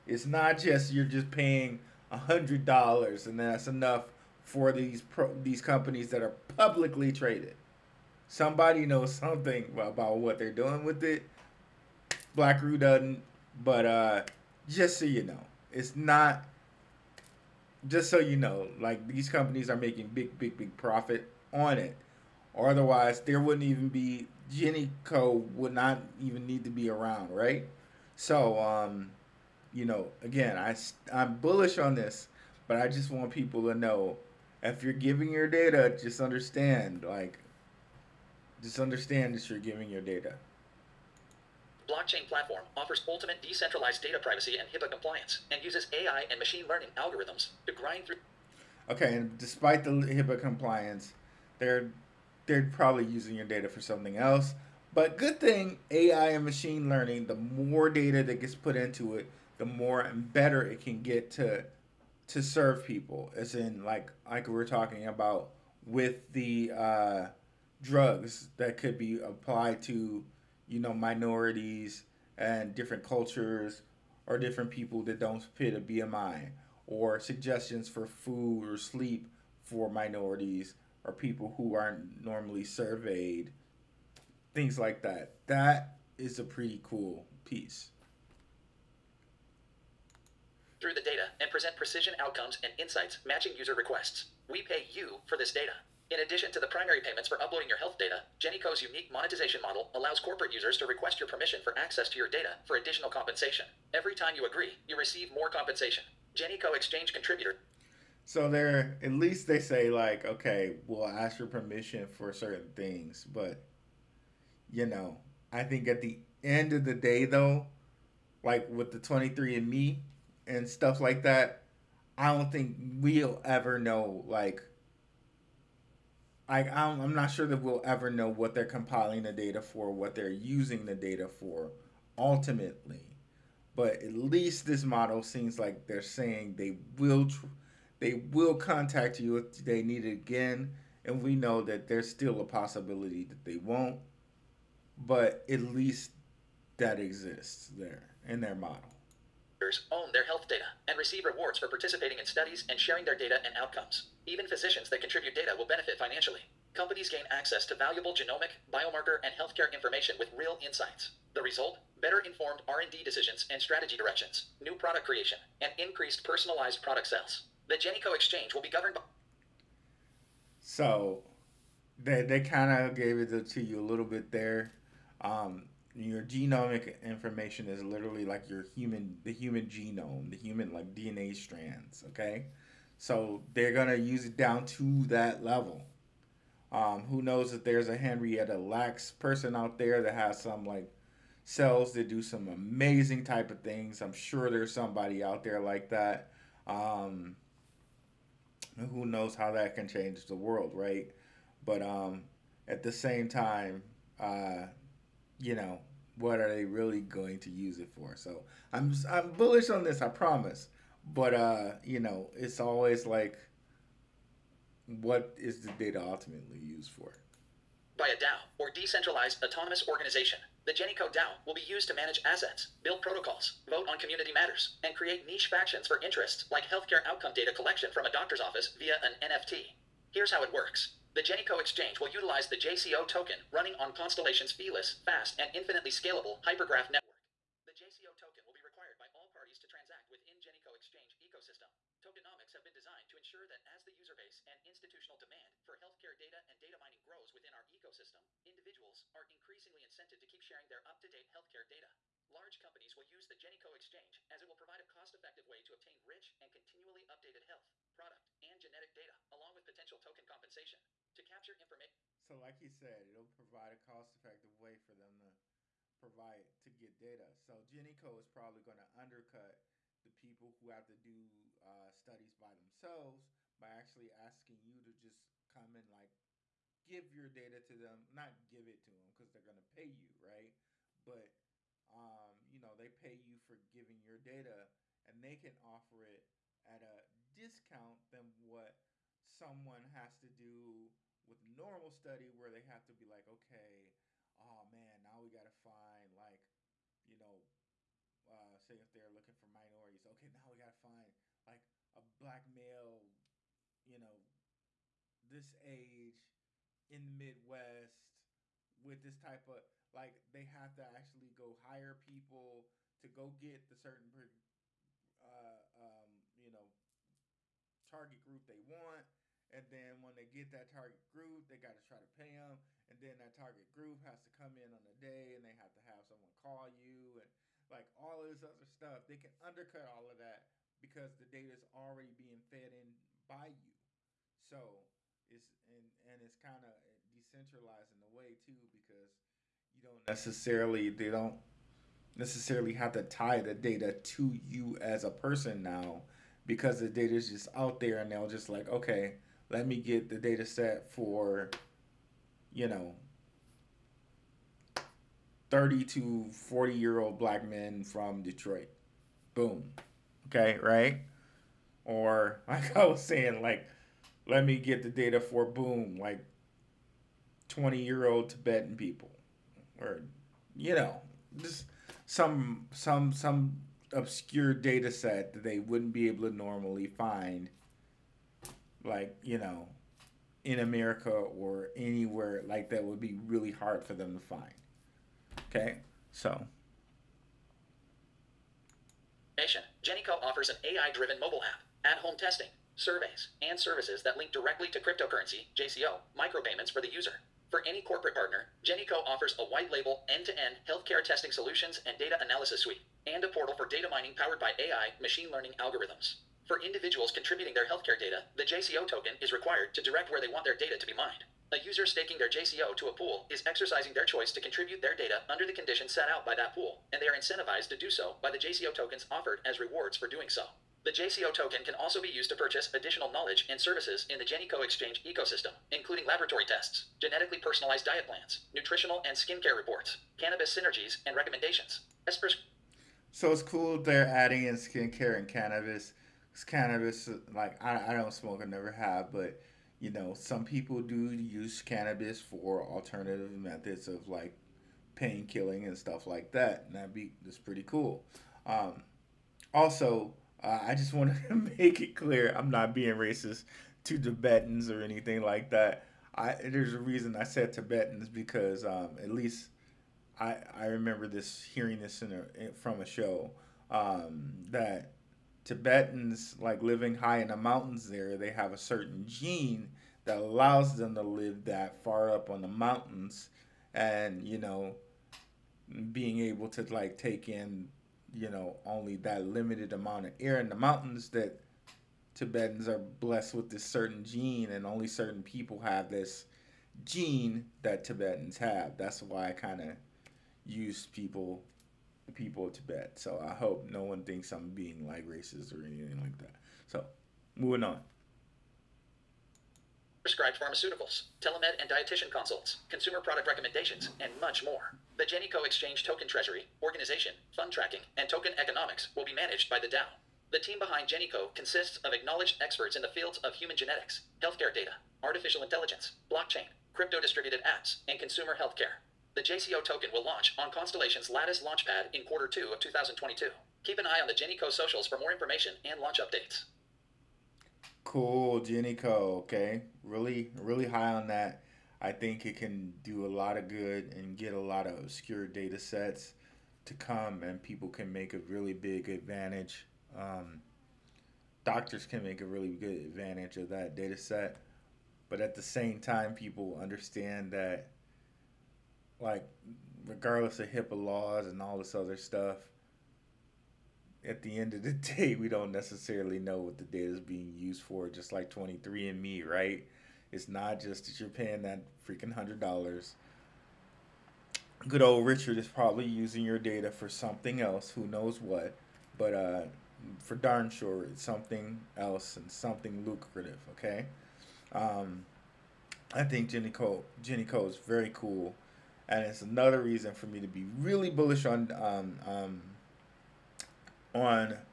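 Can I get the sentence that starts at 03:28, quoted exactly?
So I'm I'm bullish on this, I promise.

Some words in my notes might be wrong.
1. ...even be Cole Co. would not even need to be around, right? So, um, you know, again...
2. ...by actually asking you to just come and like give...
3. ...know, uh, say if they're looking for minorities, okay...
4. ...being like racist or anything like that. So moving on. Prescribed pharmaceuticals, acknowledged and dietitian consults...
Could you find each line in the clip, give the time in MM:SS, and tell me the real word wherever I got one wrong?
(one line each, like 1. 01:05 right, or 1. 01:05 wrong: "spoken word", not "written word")
1. 00:23 wrong: "Jenny", not "Cole"
2. 04:33 right
3. 04:57 right
4. 08:14 wrong: "telemed", not "acknowledged".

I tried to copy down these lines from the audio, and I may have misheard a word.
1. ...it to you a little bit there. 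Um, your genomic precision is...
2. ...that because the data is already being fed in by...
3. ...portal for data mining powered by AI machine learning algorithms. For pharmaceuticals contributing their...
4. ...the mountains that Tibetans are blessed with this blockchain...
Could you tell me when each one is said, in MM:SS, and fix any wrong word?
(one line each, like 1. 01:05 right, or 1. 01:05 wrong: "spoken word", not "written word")
1. 02:53 wrong: "information", not "precision"
2. 05:30 right
3. 06:43 wrong: "individuals", not "pharmaceuticals"
4. 08:00 wrong: "certain", not "blockchain".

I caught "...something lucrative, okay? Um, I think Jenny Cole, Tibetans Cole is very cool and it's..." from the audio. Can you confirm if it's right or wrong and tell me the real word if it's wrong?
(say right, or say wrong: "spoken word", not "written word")
wrong: "Jenny", not "Tibetans".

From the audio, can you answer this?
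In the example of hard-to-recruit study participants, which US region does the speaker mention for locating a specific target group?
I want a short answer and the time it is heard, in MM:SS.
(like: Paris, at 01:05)
Midwest, at 05:07.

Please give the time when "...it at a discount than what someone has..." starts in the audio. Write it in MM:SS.
04:46.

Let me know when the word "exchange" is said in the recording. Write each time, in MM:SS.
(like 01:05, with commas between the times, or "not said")
01:46, 02:48, 03:51, 04:00, 04:13, 07:04, 08:25.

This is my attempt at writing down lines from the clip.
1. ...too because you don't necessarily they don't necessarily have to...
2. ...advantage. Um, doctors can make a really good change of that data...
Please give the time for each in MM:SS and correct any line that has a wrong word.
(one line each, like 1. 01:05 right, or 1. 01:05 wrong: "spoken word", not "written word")
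1. 05:38 right
2. 08:58 wrong: "advantage", not "change".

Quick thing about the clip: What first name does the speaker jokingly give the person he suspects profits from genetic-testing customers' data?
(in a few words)
Richard.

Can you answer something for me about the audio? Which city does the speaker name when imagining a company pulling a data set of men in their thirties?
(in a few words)
Detroit.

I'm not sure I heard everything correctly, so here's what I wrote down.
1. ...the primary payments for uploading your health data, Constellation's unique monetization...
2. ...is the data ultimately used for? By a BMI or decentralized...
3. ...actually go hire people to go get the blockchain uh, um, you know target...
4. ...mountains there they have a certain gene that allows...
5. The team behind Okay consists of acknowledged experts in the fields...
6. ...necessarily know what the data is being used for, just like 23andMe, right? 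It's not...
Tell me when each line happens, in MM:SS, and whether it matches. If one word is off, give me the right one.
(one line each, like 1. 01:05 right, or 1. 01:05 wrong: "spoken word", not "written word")
1. 01:36 wrong: "Jennyco", not "Constellation"
2. 03:35 wrong: "DAO", not "BMI"
3. 05:10 wrong: "certain", not "blockchain"
4. 07:47 right
5. 08:30 wrong: "Jennyco", not "Okay"
6. 09:15 right.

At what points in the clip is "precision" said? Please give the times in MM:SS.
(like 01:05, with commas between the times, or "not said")
01:31.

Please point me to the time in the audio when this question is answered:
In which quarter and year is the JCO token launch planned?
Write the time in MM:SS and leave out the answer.
08:42.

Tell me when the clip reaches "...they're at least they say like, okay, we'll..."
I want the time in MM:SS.
01:48.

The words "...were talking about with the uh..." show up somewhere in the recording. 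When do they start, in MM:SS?
01:04.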